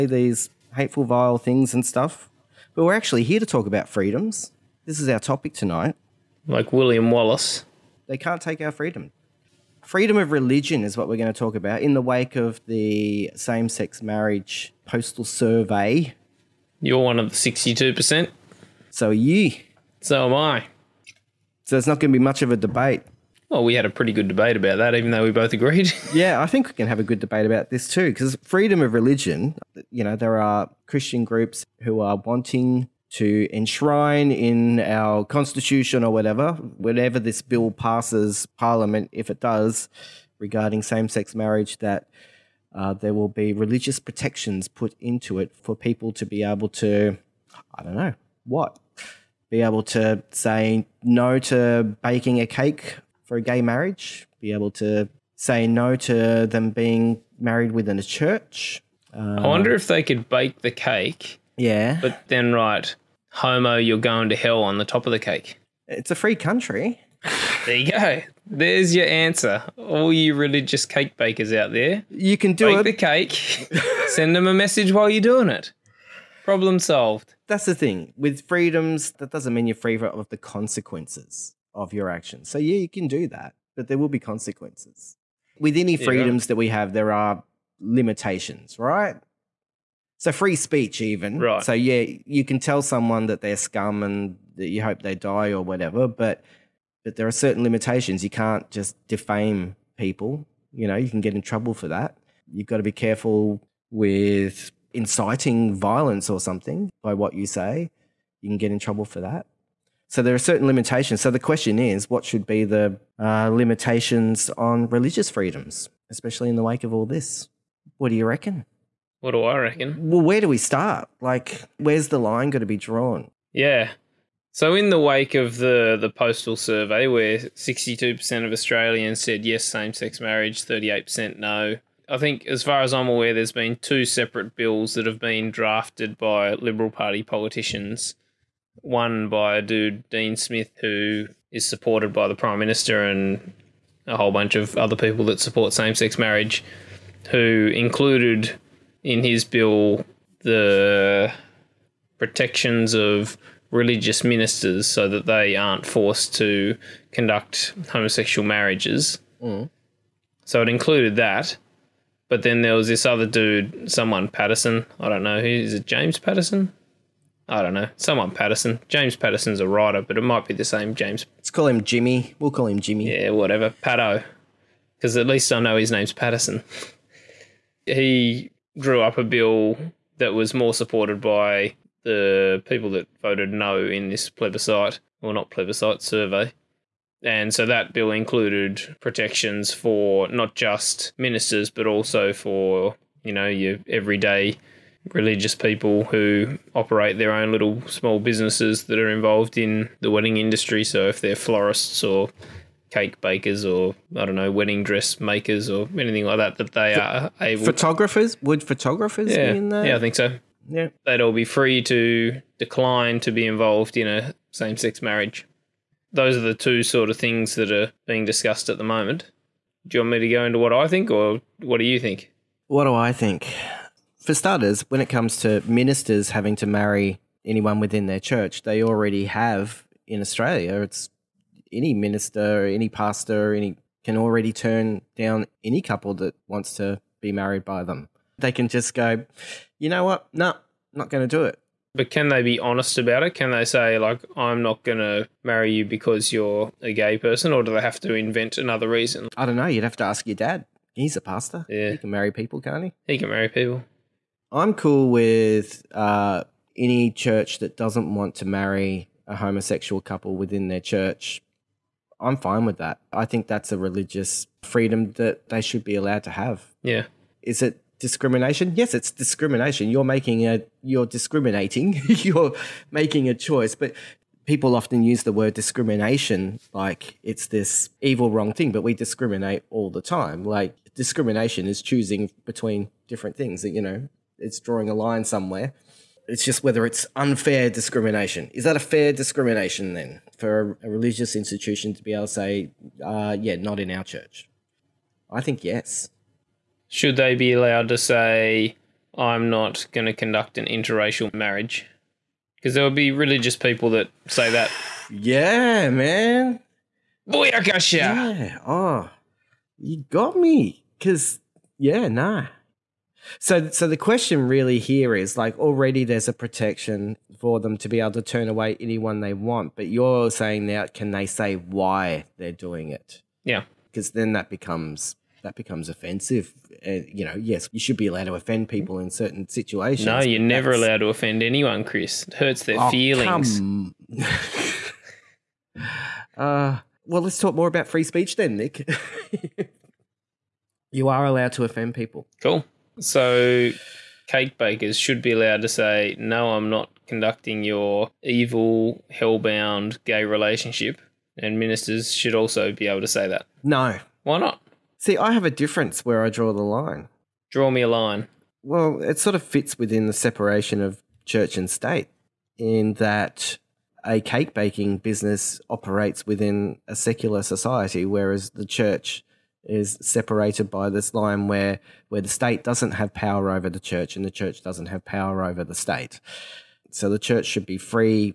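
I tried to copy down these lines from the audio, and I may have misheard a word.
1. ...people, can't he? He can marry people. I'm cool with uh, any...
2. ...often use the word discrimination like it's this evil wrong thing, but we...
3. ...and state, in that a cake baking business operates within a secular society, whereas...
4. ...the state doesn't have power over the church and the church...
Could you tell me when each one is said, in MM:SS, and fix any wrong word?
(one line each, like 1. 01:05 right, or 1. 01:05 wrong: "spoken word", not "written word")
1. 04:12 right
2. 04:34 right
3. 06:01 right
4. 06:12 right.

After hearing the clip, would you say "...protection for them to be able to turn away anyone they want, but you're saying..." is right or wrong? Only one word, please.
right.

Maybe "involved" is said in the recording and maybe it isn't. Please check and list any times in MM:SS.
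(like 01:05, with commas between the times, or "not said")
03:19, 03:33.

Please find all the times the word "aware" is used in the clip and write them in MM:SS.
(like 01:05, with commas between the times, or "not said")
02:13.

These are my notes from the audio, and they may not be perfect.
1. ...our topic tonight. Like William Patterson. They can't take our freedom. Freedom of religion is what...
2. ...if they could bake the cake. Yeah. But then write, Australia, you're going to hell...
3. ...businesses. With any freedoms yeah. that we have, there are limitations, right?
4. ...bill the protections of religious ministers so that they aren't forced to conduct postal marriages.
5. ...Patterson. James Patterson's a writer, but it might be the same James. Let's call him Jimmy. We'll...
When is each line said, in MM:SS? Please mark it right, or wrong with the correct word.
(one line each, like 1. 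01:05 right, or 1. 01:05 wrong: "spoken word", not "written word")
1. 00:05 wrong: "Wallace", not "Patterson"
2. 00:59 wrong: "Homo", not "Australia"
3. 01:24 wrong: "consequences", not "businesses"
4. 02:29 wrong: "homosexual", not "postal"
5. 02:48 right.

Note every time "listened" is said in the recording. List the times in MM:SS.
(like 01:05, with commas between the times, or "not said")
not said.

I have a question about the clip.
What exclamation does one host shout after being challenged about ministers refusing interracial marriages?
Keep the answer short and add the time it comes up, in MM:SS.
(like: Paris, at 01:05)
Booyakasha, at 05:07.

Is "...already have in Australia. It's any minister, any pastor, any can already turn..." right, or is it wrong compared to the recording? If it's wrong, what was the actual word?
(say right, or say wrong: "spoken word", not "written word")
right.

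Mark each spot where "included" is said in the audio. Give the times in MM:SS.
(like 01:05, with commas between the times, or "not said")
02:27, 02:40, 03:08.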